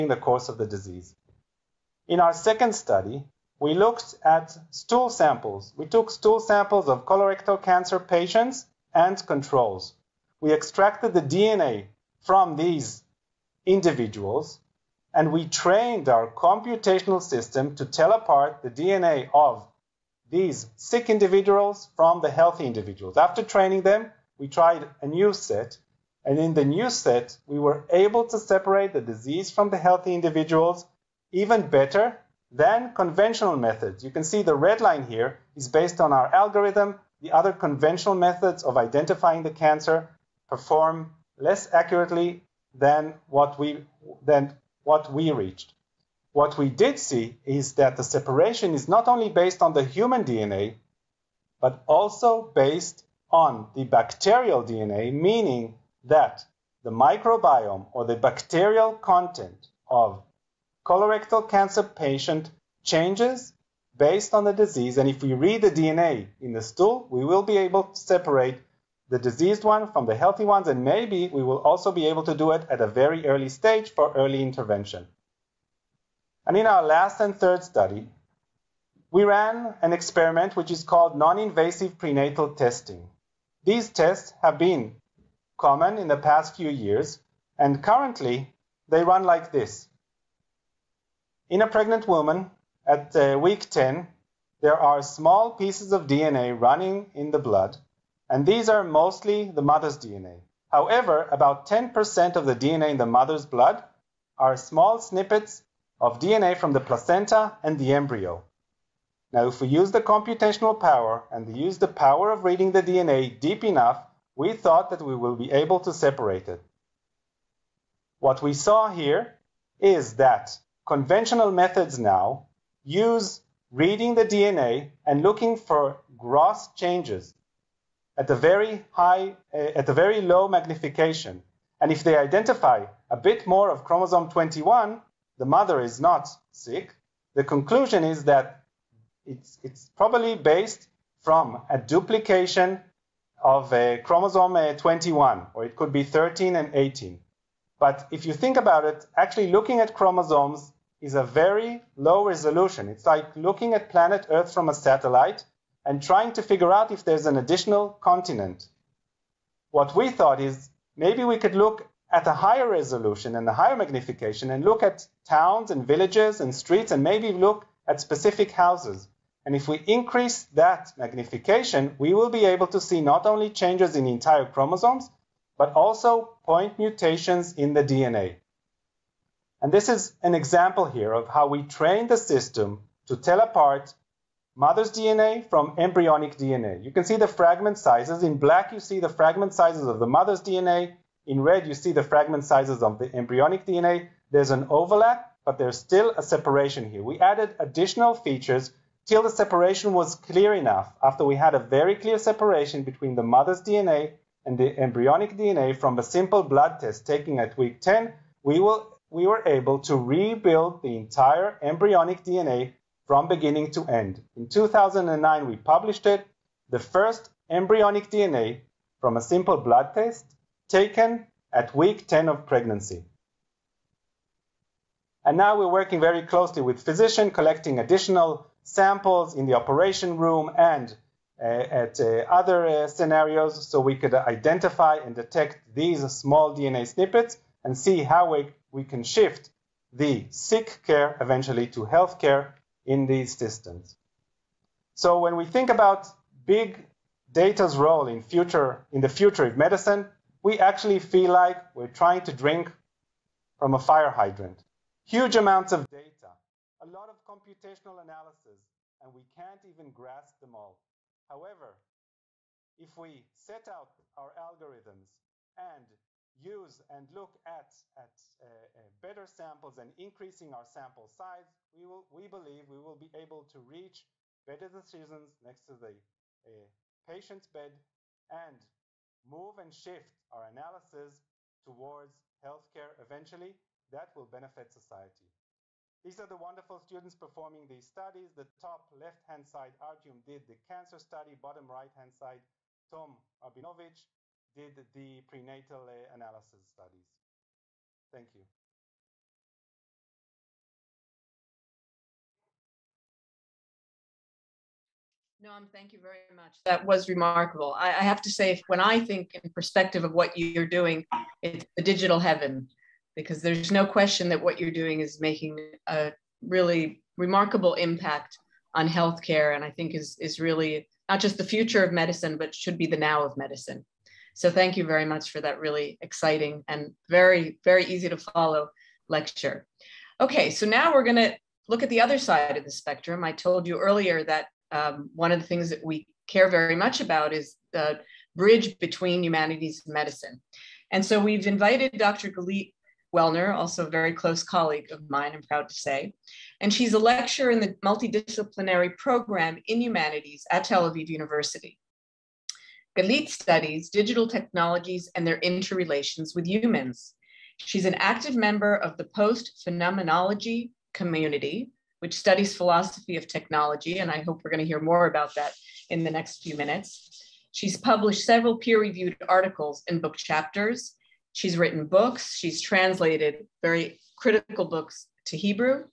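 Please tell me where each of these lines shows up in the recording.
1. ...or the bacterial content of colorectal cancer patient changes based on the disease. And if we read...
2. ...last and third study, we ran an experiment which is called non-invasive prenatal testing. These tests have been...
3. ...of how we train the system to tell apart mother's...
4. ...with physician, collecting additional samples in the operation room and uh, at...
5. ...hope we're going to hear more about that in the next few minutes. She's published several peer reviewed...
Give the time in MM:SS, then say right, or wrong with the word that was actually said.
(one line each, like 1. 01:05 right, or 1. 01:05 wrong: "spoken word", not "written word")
1. 00:57 right
2. 01:16 right
3. 03:01 right
4. 03:46 right
5. 06:04 right.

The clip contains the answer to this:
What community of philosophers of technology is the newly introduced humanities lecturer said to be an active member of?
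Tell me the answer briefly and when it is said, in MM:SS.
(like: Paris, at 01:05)
post phenomenology, at 05:59.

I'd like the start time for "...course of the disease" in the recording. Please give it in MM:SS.
00:00.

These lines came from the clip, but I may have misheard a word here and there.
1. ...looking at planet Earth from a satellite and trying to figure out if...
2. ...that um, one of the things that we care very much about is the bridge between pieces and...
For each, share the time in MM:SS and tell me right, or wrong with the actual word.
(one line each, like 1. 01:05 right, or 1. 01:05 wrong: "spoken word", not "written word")
1. 02:33 right
2. 05:34 wrong: "humanities", not "pieces".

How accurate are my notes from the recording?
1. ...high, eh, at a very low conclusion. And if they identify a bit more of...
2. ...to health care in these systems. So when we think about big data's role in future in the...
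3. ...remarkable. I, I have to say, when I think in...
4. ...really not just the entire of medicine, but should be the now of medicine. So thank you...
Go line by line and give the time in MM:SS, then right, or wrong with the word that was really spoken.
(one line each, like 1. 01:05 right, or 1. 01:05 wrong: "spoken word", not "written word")
1. 02:08 wrong: "magnification", not "conclusion"
2. 04:01 right
3. 05:07 right
4. 05:20 wrong: "future", not "entire".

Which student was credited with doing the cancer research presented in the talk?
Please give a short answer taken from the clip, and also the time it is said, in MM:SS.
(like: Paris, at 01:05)
Artyom, at 04:49.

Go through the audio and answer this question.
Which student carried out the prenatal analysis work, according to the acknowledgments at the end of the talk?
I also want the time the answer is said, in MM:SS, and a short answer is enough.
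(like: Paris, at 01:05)
Tom Abinovich, at 04:52.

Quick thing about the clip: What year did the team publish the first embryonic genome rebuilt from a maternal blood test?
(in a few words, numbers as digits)
2009.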